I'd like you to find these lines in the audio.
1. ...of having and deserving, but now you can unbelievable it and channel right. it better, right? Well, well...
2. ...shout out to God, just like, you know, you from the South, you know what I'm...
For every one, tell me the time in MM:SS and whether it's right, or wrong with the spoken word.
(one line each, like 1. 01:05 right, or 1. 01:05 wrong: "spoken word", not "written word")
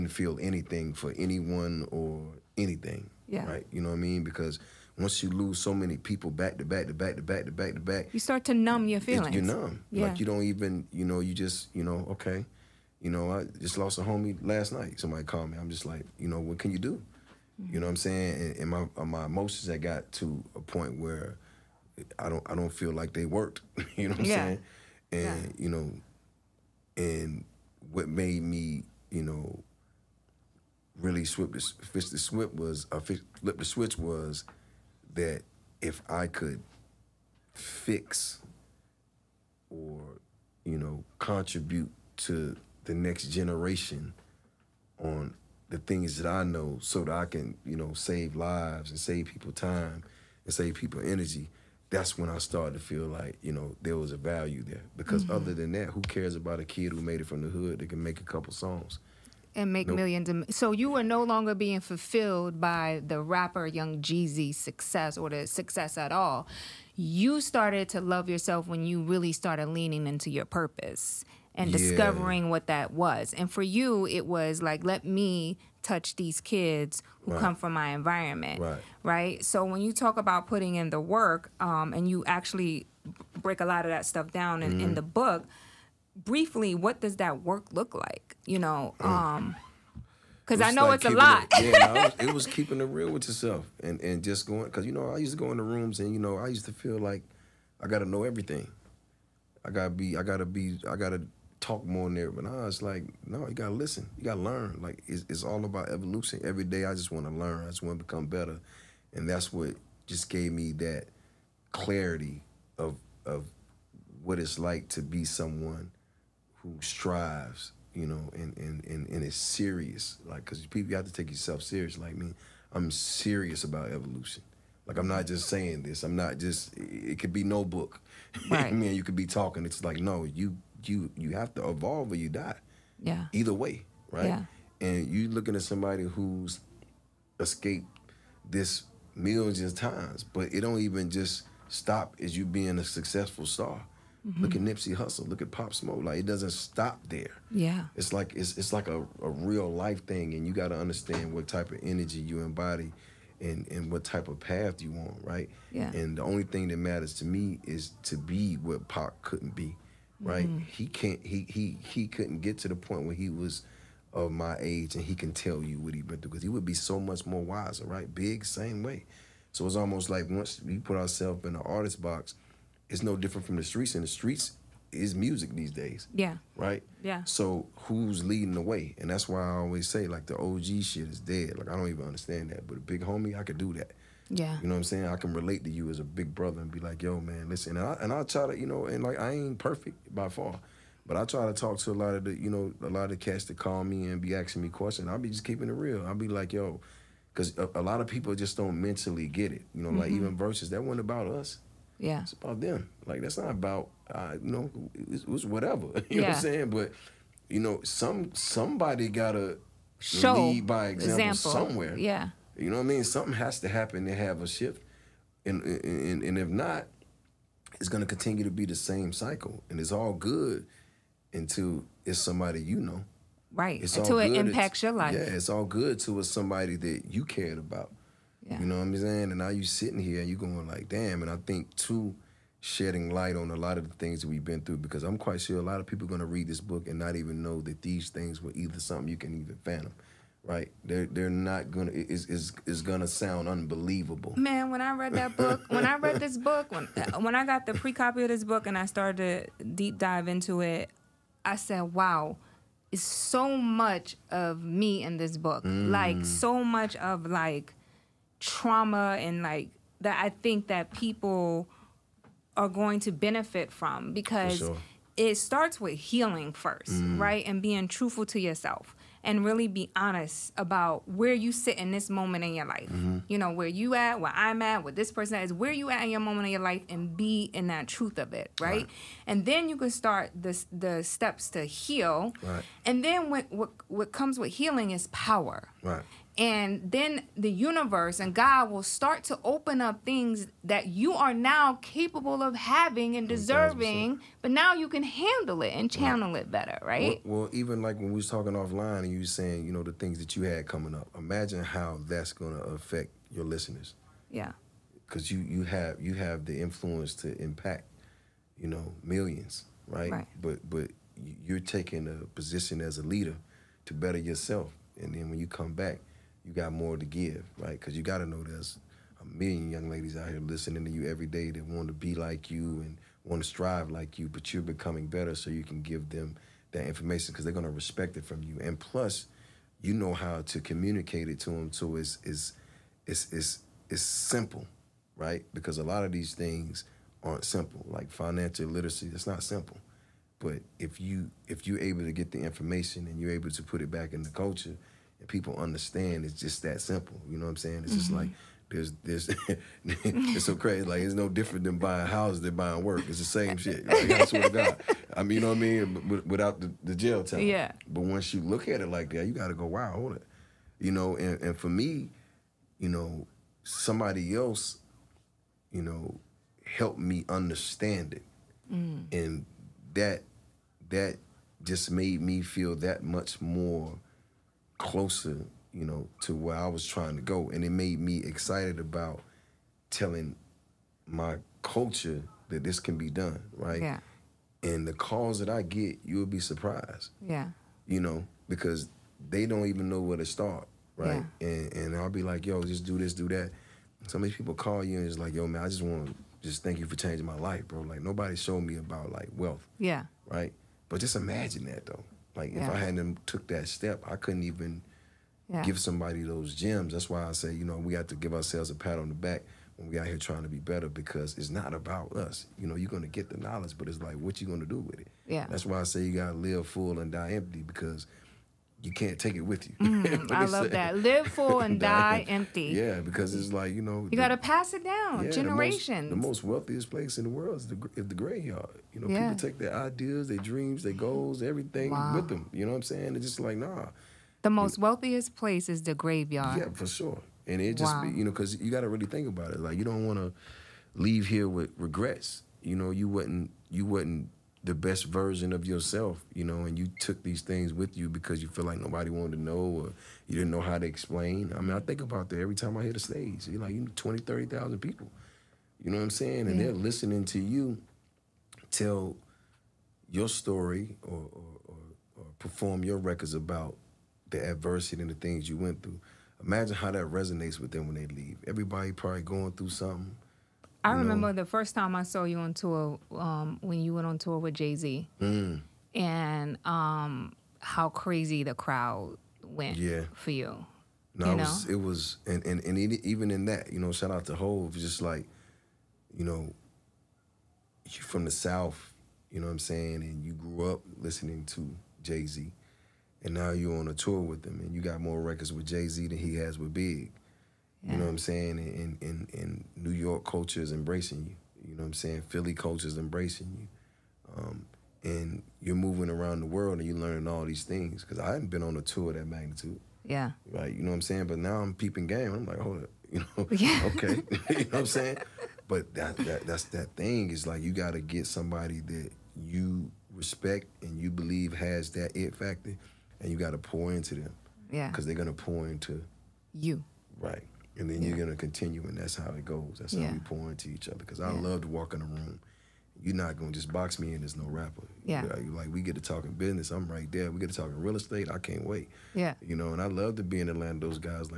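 1. 04:52 wrong: "handle", not "unbelievable"
2. 08:03 wrong: "Hove", not "God".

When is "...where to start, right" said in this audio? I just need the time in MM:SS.
06:29.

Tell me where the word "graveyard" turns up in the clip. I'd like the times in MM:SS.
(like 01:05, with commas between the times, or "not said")
07:08, 07:15.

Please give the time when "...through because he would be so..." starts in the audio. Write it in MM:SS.
02:46.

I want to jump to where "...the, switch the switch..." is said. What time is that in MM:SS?
00:31.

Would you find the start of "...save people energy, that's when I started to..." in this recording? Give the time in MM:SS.
00:50.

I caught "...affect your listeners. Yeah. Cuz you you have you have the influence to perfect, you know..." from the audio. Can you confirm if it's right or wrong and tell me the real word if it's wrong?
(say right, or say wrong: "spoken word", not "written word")
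wrong: "impact", not "perfect".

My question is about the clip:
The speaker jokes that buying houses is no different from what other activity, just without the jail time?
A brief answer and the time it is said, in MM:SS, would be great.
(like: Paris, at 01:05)
Buying work, at 05:52.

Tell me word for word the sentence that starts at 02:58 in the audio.
And that's why I always say, like, the OG shit is dead.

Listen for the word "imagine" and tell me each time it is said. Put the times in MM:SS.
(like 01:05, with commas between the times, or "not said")
05:01, 06:41, 07:46.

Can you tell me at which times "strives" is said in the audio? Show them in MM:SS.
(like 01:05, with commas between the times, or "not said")
01:56, 05:23.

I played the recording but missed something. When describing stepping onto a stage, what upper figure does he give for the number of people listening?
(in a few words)
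30,000.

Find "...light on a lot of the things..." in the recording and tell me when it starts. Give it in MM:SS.
03:53.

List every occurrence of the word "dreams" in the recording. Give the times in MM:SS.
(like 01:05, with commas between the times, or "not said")
07:10.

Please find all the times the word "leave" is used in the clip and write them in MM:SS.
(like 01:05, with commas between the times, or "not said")
07:20, 07:48.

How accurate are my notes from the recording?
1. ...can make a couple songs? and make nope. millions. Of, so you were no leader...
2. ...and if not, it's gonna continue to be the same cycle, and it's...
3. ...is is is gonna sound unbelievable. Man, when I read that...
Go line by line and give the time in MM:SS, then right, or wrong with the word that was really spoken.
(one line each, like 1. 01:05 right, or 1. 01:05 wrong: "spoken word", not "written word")
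1. 00:57 wrong: "longer", not "leader"
2. 03:36 right
3. 04:01 right.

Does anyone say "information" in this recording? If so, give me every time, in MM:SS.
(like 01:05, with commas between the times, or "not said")
05:26, 05:42.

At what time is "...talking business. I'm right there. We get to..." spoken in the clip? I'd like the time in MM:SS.
08:56.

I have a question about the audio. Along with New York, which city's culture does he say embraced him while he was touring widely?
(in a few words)
Philly.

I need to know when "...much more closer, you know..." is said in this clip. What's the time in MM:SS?
06:13.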